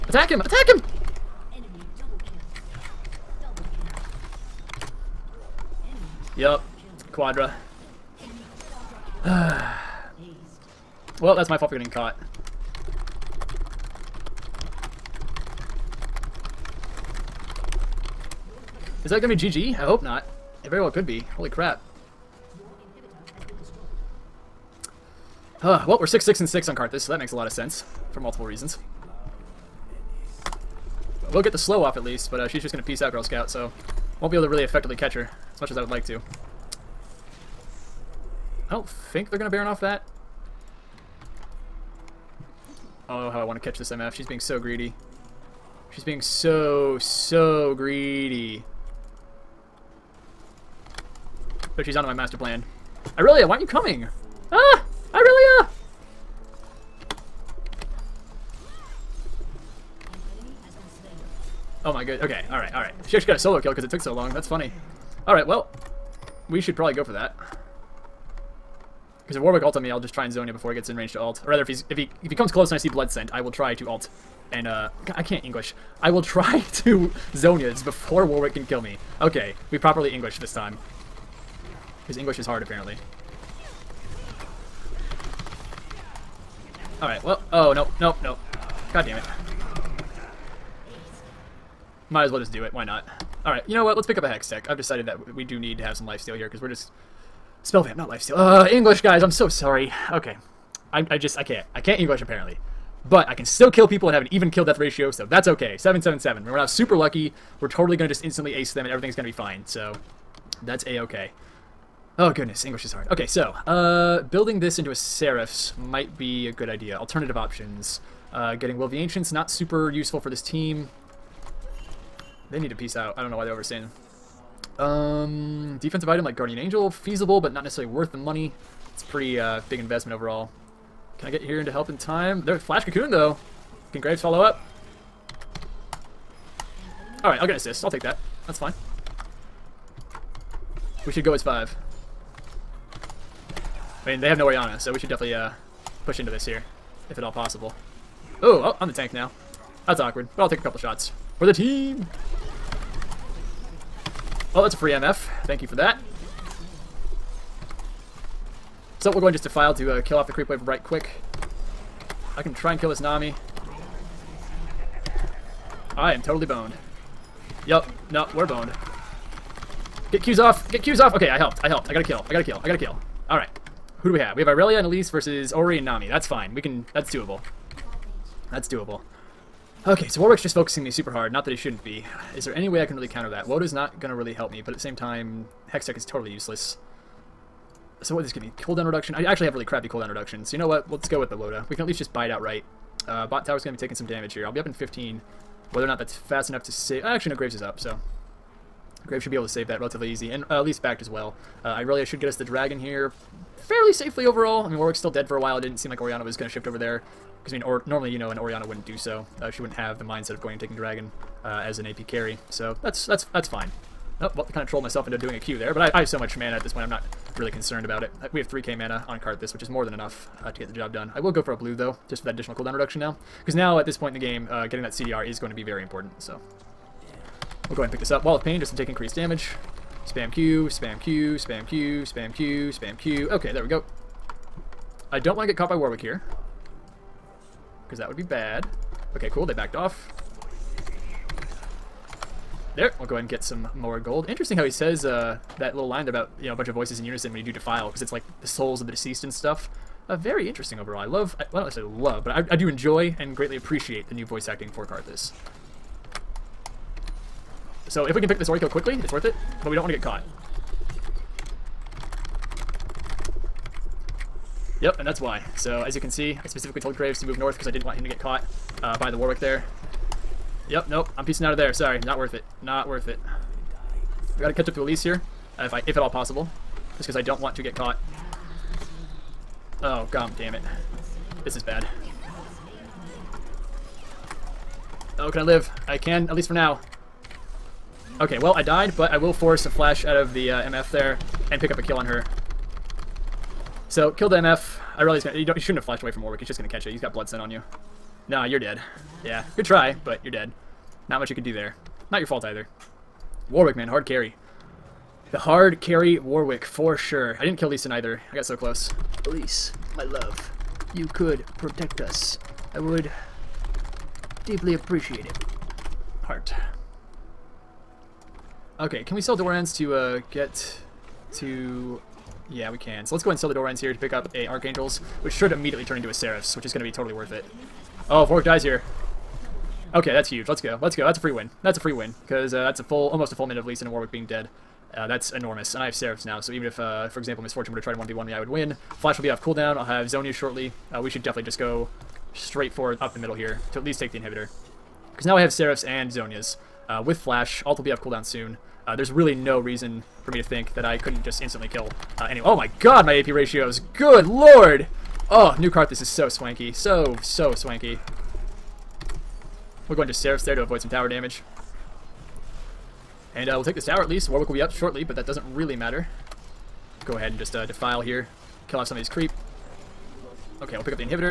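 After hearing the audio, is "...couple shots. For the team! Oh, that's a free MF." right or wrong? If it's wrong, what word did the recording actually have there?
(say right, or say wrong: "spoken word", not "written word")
right.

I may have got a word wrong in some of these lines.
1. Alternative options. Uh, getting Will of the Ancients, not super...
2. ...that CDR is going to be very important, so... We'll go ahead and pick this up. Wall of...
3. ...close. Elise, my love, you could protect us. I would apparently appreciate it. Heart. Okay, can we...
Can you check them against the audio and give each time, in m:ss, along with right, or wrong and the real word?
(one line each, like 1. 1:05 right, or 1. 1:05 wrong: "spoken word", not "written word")
1. 1:56 right
2. 3:44 right
3. 5:08 wrong: "deeply", not "apparently".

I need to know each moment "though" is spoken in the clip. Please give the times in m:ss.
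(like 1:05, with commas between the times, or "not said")
2:13, 3:41.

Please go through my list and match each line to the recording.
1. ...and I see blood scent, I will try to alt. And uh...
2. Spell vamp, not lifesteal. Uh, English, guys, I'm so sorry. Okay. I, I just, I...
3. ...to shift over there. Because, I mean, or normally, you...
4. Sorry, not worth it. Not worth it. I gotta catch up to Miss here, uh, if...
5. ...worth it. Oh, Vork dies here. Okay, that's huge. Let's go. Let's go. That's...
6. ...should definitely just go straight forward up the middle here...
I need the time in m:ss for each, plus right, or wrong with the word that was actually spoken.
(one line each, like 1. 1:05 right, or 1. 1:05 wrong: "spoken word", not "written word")
1. 1:12 right
2. 1:37 right
3. 3:26 right
4. 4:31 wrong: "Elise", not "Miss"
5. 5:27 right
6. 5:41 right.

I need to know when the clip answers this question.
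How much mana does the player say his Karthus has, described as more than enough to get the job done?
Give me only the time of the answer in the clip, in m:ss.
3:38.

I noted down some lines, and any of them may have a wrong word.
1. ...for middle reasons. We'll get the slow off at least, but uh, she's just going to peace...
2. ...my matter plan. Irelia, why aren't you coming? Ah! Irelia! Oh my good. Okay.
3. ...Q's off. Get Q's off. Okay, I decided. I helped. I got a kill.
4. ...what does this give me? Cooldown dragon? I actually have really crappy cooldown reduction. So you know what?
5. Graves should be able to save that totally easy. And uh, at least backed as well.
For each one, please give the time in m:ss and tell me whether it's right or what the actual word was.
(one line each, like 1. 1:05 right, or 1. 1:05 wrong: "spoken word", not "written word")
1. 0:28 wrong: "multiple", not "middle"
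2. 0:52 wrong: "master", not "matter"
3. 2:50 wrong: "helped", not "decided"
4. 3:08 wrong: "reduction", not "dragon"
5. 3:19 wrong: "relatively", not "totally".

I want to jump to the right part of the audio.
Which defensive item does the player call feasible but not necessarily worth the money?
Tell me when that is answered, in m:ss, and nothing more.
2:06.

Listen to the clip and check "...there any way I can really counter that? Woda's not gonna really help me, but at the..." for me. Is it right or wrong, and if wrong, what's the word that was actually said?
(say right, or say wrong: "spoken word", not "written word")
right.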